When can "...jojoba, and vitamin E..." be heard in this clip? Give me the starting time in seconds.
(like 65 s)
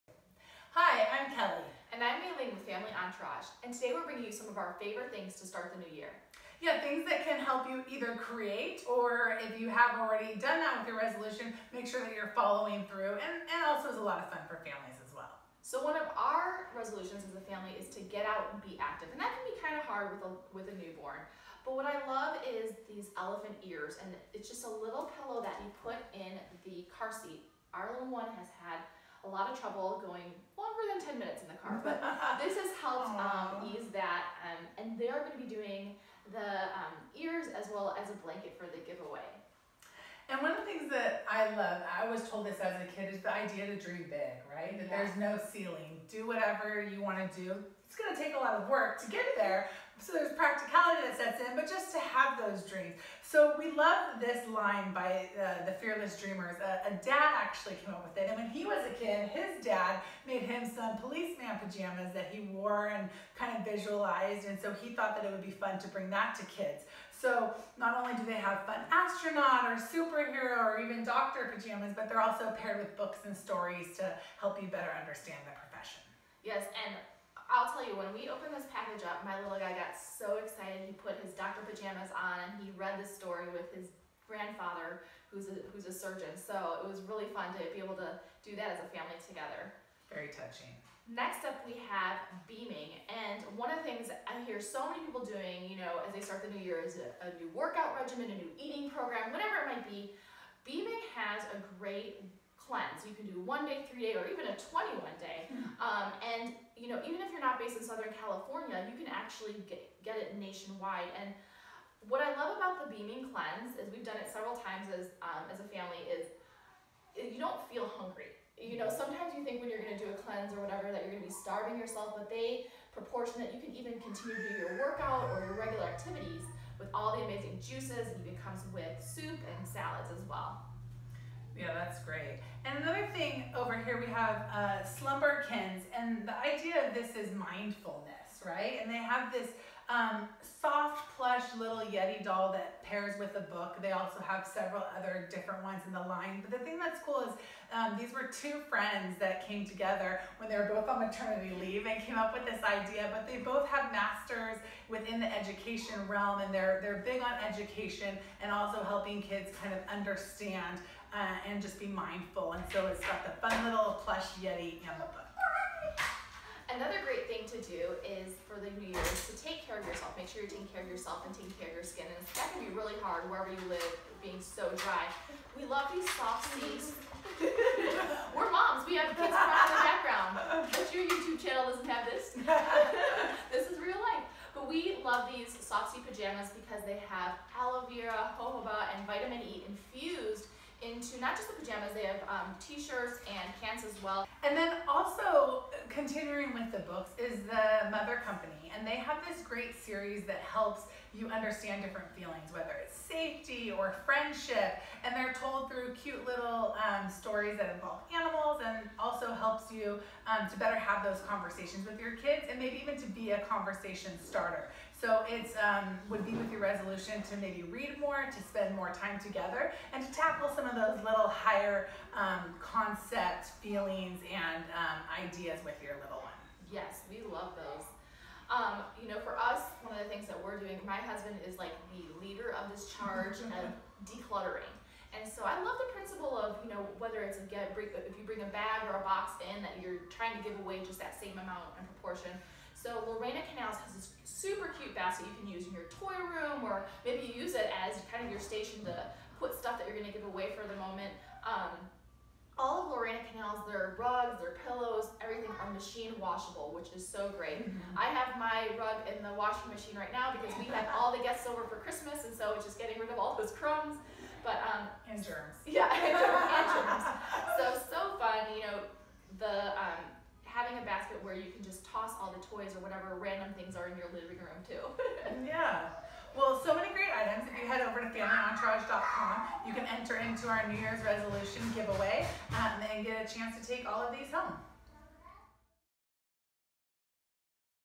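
188 s.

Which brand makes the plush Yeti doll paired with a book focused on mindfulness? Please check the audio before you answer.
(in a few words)
Slumberkins.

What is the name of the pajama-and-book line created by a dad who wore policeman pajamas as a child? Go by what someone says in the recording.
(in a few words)
Fearless Dreamers.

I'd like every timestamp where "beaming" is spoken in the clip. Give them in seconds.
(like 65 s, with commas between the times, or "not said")
92 s, 100 s, 112 s.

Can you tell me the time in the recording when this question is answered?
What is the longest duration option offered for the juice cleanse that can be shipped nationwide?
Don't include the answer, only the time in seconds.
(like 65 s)
104 s.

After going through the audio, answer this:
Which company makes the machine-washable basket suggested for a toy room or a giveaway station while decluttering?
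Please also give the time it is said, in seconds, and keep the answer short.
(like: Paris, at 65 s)
Lorena Canals, at 243 s.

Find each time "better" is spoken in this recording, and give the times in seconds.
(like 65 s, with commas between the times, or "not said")
74 s, 210 s.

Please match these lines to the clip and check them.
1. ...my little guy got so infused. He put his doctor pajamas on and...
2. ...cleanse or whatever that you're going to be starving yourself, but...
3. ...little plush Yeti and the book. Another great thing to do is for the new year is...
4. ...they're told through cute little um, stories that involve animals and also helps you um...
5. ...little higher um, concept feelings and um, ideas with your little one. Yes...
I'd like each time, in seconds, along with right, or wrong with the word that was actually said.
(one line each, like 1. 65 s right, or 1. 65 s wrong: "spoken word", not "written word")
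1. 79 s wrong: "excited", not "infused"
2. 120 s right
3. 163 s right
4. 205 s right
5. 221 s right.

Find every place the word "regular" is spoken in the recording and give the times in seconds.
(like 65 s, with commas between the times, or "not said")
125 s.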